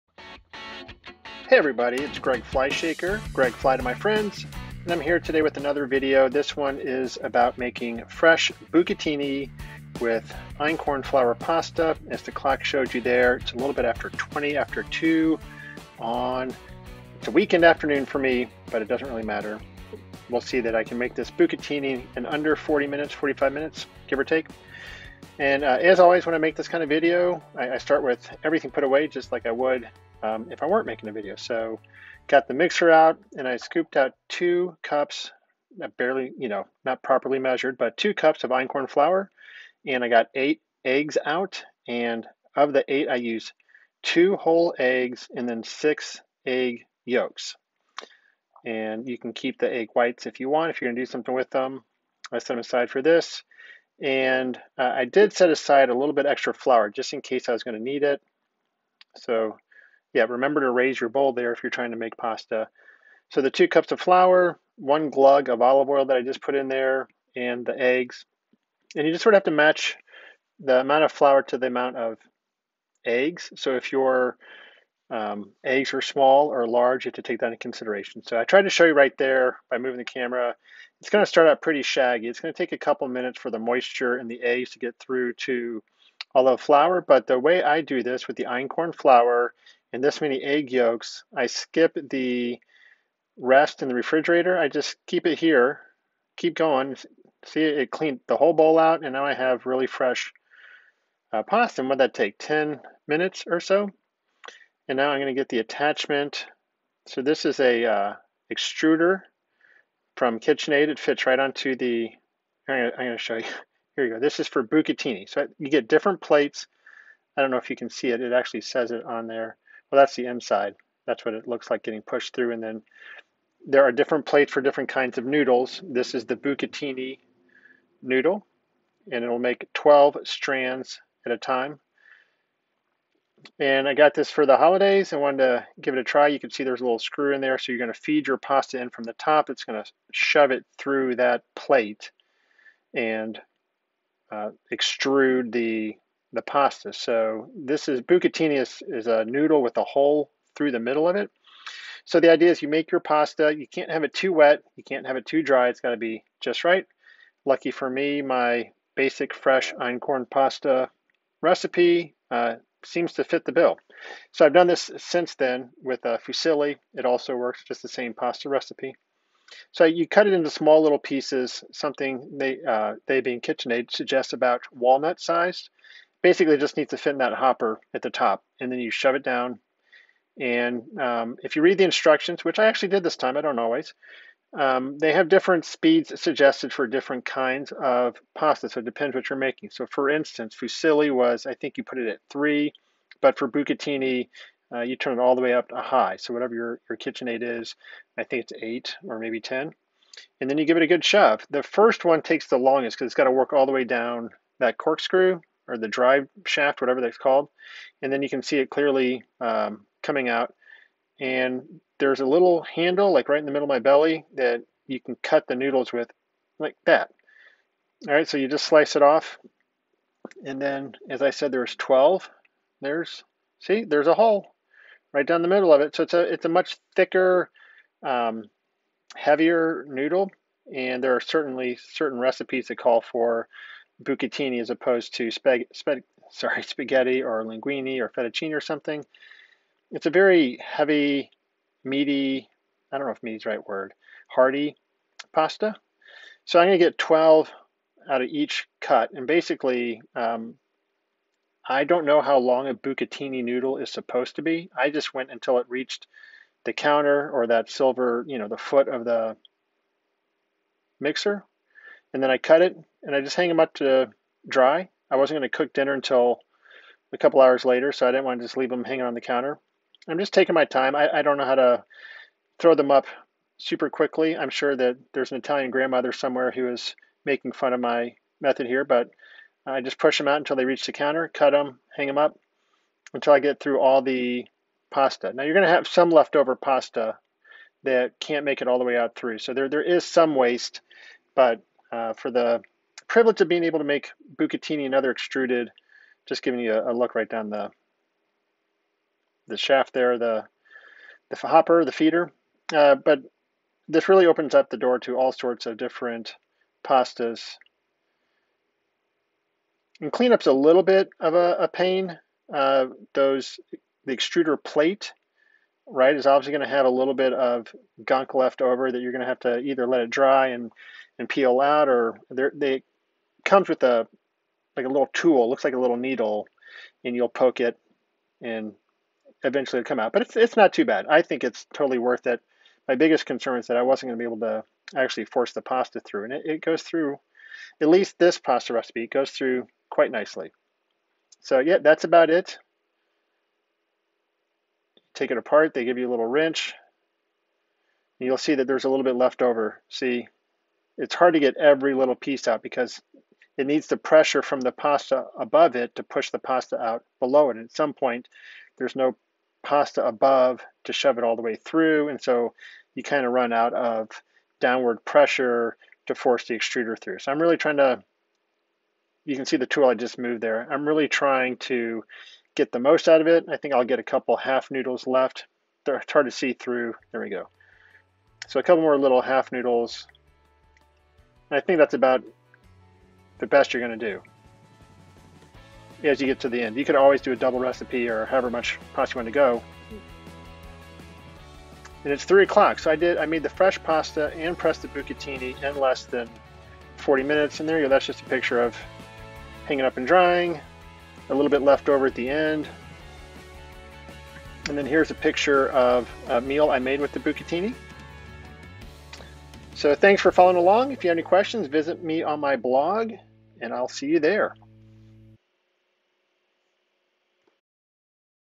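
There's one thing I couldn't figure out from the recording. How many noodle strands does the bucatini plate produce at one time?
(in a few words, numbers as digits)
12.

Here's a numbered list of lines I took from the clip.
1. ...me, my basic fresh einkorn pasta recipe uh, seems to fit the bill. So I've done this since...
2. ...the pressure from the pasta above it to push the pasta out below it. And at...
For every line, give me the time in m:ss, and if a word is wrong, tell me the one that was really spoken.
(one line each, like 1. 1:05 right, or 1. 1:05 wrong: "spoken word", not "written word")
1. 2:37 right
2. 5:53 right.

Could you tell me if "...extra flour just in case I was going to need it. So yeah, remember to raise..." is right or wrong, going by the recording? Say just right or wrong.
right.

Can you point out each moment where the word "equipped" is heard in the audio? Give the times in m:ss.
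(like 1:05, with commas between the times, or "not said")
not said.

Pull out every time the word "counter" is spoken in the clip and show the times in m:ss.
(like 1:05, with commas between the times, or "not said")
4:16, 4:29, 4:40.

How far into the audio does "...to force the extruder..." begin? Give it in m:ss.
6:06.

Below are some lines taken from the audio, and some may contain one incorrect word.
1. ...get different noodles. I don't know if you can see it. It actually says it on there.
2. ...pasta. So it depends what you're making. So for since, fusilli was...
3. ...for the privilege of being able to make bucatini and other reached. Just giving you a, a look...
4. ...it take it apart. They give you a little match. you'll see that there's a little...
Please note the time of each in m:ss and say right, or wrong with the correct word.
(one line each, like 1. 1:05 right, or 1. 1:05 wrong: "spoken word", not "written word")
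1. 1:55 wrong: "plates", not "noodles"
2. 3:08 wrong: "instance", not "since"
3. 4:52 wrong: "extruded", not "reached"
4. 5:42 wrong: "wrench", not "match".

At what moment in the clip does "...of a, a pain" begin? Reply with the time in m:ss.
5:11.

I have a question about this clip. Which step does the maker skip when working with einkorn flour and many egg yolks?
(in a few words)
rest in the refrigerator.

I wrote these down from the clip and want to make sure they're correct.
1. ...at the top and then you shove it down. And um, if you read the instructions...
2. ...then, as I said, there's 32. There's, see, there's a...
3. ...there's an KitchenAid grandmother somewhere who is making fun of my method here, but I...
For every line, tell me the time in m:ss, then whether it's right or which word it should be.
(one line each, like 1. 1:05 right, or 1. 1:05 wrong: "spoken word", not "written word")
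1. 2:57 right
2. 3:40 wrong: "12", not "32"
3. 4:35 wrong: "Italian", not "KitchenAid".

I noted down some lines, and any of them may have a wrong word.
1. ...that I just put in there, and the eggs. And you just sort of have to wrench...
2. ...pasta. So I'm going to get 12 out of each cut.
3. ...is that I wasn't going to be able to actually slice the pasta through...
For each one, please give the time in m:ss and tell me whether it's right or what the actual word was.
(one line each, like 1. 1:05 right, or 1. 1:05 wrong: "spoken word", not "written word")
1. 1:06 wrong: "match", not "wrench"
2. 4:05 right
3. 5:33 wrong: "force", not "slice".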